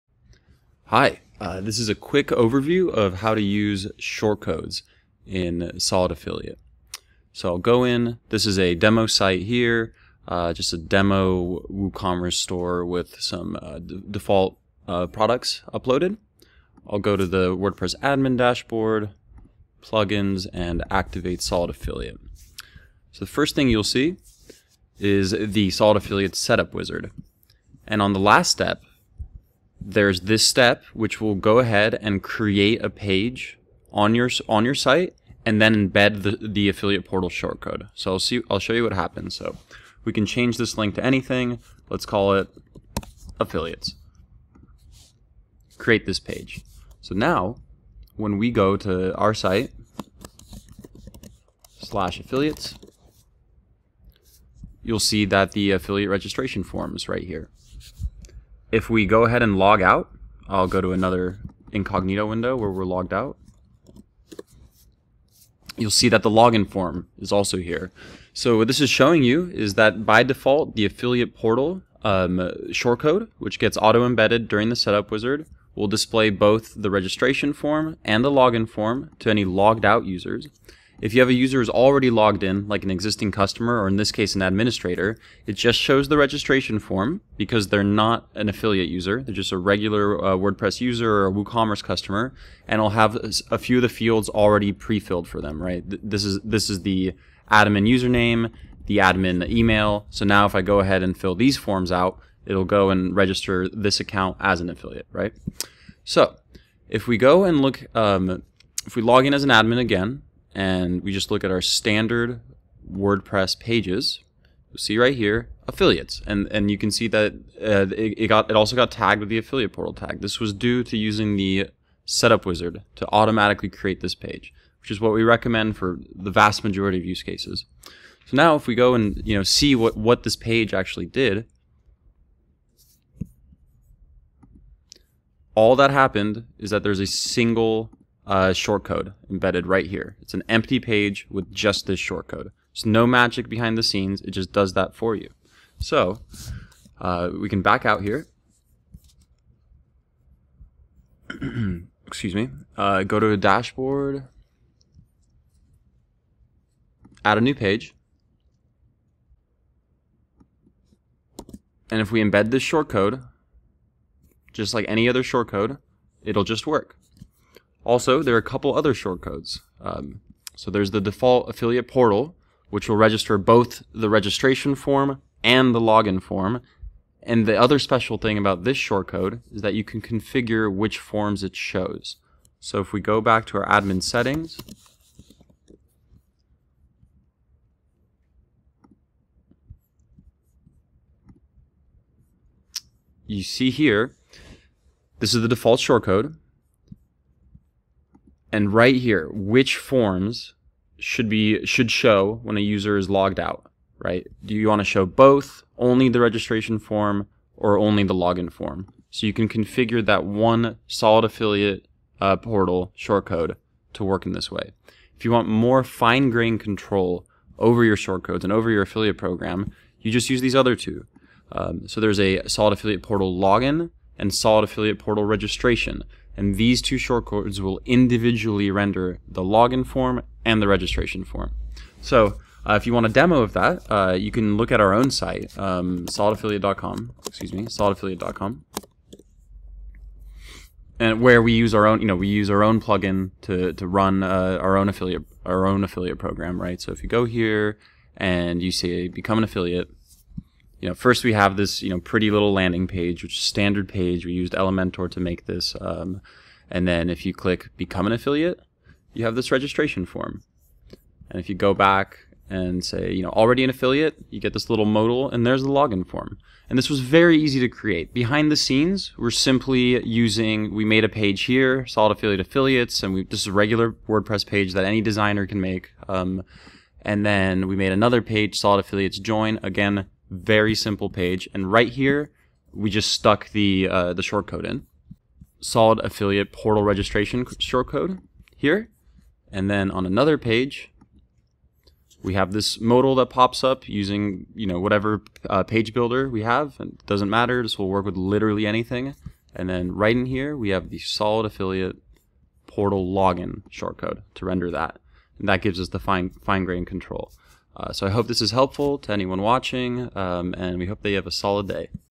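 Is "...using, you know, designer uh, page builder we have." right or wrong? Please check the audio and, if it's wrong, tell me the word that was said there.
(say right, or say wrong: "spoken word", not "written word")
wrong: "whatever", not "designer".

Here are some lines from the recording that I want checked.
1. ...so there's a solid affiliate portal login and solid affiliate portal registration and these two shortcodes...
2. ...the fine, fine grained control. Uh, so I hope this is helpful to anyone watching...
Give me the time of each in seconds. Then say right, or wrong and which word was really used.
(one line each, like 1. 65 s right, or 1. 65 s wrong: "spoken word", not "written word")
1. 221 s right
2. 305 s right.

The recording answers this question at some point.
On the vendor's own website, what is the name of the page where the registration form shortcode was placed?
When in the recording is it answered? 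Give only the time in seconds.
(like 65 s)
278 s.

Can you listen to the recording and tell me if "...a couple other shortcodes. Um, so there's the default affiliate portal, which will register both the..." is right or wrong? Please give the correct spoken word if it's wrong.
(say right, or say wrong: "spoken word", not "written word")
right.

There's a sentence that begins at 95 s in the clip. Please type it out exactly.
This is, this is the admin username, the admin email.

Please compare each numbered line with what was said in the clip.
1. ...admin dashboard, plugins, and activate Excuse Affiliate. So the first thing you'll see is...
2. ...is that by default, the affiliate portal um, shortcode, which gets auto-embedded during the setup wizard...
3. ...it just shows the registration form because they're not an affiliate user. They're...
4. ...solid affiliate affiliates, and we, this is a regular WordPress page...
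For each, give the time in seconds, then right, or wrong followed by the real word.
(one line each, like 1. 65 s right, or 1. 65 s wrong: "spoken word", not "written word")
1. 18 s wrong: "Solid", not "Excuse"
2. 69 s right
3. 85 s right
4. 271 s right.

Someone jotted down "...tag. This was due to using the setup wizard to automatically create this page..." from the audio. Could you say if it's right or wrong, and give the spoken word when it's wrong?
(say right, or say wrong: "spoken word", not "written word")
right.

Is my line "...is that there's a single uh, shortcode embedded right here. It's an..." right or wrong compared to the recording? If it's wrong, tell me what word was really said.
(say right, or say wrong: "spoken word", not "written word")
right.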